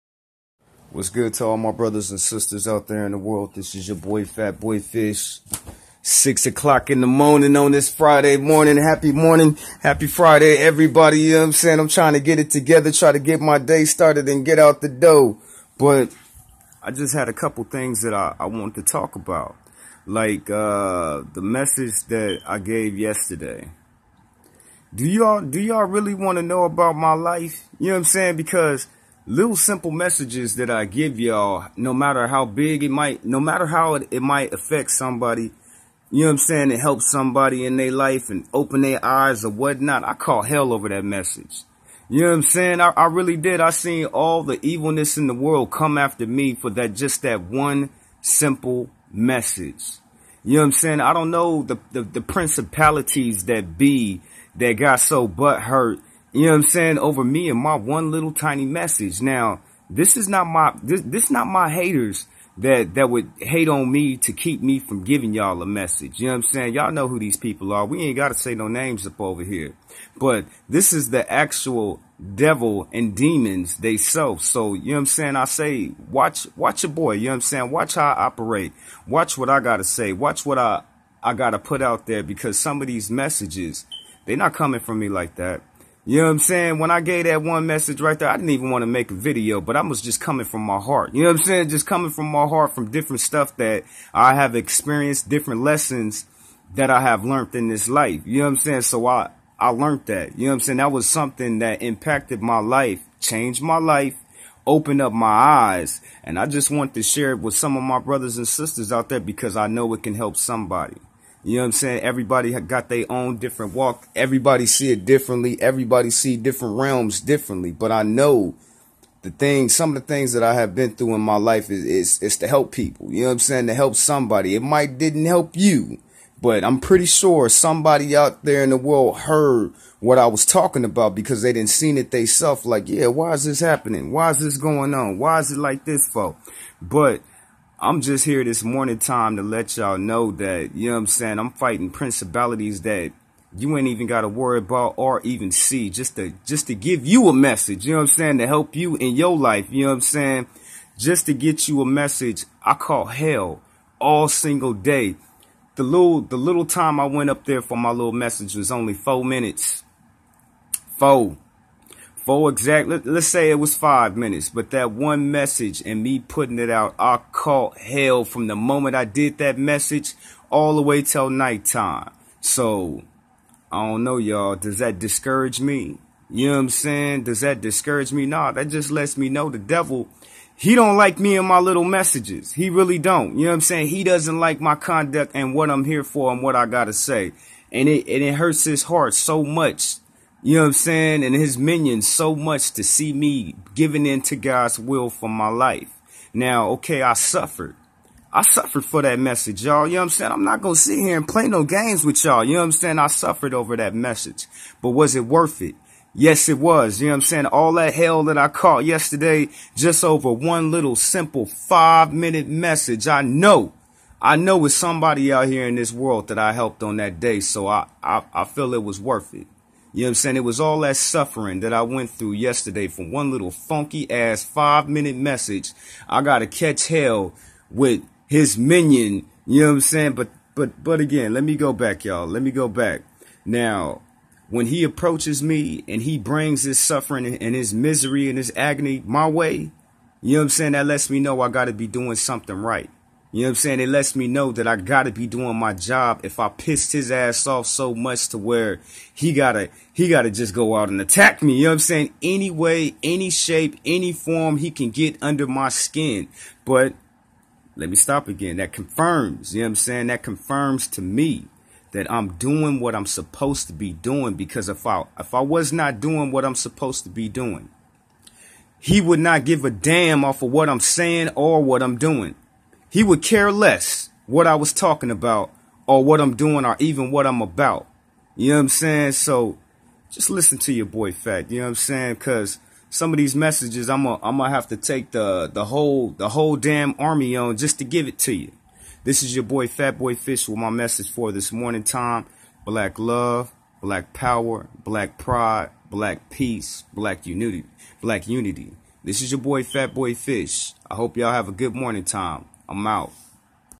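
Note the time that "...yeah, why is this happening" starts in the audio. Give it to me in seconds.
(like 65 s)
132 s.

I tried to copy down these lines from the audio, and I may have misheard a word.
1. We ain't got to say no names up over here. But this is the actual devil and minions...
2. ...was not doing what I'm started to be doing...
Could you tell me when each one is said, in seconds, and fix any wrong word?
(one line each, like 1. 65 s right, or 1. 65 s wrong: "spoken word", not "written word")
1. 67 s wrong: "demons", not "minions"
2. 265 s wrong: "supposed", not "started".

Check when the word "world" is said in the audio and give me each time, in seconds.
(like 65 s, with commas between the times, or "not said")
3 s, 45 s, 128 s, 215 s.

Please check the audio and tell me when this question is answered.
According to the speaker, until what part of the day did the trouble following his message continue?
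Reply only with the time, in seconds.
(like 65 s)
171 s.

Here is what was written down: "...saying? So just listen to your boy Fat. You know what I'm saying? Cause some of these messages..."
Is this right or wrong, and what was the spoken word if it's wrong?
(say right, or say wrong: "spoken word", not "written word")
right.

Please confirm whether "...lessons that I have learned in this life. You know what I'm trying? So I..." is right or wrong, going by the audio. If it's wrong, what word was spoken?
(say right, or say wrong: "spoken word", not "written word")
wrong: "saying", not "trying".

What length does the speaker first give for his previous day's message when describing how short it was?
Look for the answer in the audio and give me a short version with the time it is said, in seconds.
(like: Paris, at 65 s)
4 minutes, at 158 s.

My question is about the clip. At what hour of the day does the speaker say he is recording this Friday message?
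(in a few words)
6 o'clock.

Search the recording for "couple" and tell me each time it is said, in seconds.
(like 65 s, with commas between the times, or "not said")
17 s.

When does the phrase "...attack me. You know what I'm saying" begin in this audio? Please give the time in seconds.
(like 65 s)
250 s.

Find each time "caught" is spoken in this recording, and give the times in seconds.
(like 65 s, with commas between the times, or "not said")
167 s, 208 s.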